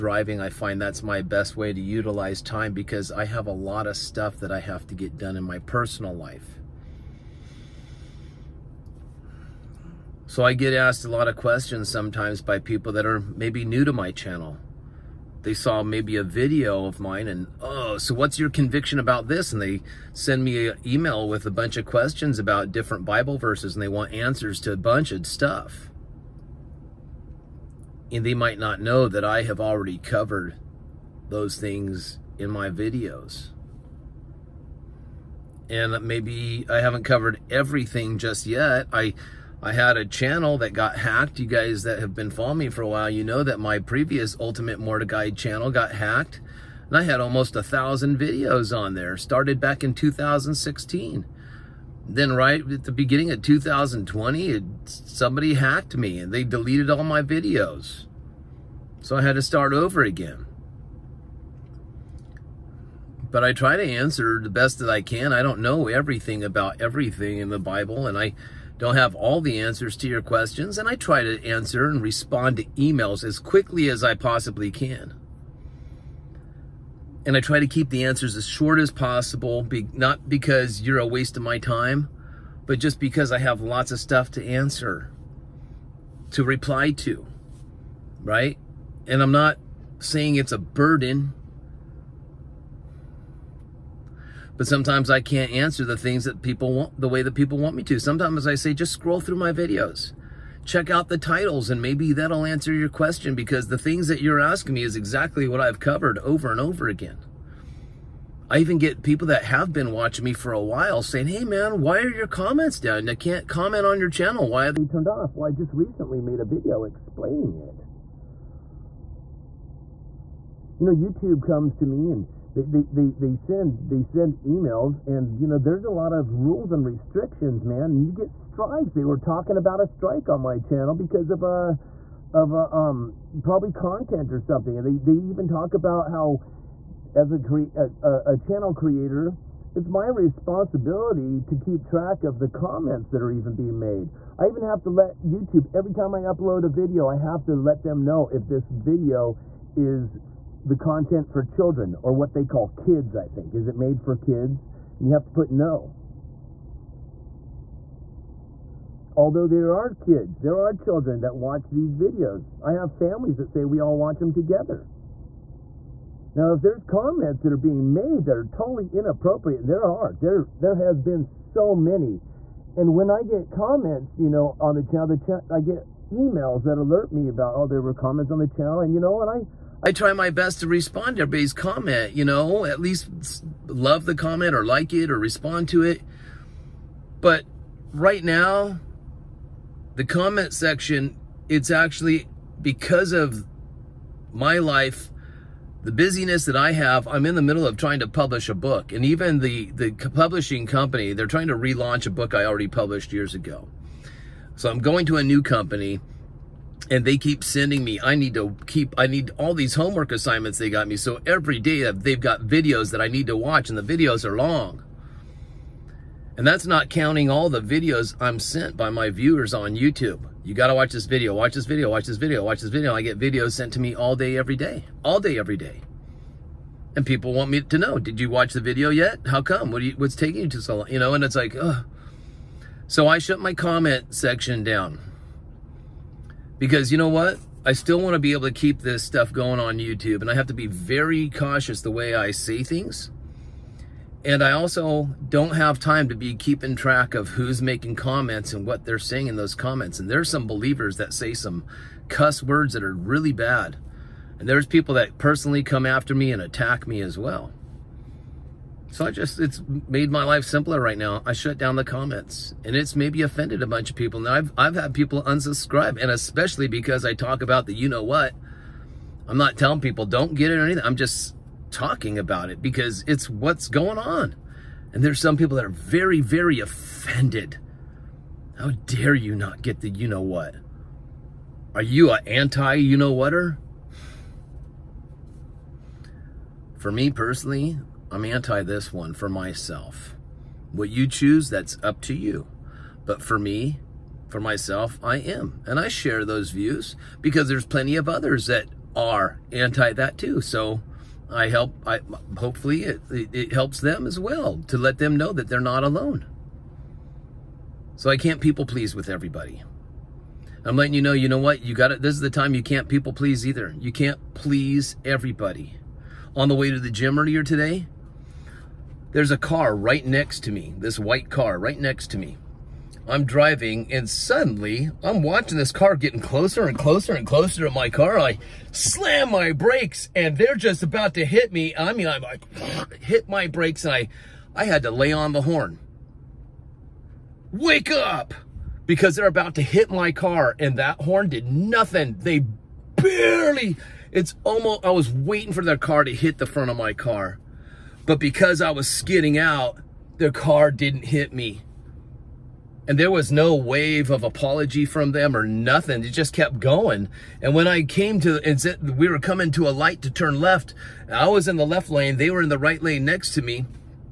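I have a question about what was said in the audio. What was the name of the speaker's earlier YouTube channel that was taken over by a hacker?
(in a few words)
Ultimate Mordecai.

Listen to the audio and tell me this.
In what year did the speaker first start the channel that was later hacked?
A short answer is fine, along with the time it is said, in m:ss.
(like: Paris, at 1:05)
2016, at 0:49.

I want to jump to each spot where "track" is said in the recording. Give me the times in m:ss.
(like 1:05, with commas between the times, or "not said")
2:21, 4:06.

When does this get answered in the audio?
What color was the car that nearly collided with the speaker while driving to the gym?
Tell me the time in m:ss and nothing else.
5:20.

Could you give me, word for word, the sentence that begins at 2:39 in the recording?
Although there are kids, there are children that watch these videos.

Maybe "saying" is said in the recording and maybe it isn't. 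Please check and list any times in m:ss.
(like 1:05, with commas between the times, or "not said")
1:29, 1:51, 4:08.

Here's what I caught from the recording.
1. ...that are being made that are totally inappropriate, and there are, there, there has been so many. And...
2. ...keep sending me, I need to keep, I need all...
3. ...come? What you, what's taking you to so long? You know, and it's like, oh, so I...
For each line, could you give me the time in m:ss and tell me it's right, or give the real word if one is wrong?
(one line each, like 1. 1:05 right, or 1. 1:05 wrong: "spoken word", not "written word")
1. 2:47 right
2. 3:27 right
3. 3:49 right.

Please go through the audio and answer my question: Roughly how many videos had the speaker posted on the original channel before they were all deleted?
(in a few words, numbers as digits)
almost 1000.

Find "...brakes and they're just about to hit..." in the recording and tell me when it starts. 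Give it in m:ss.
5:29.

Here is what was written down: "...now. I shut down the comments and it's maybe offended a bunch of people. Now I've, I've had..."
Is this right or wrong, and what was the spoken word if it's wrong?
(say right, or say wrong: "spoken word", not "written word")
right.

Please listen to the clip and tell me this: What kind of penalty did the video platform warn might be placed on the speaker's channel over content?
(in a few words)
a strike.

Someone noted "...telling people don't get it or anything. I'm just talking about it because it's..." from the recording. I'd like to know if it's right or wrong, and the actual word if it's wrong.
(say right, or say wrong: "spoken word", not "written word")
right.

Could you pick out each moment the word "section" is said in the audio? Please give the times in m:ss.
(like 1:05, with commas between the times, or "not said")
3:10, 3:54.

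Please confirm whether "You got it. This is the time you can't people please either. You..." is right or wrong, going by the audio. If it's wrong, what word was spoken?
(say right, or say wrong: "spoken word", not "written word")
right.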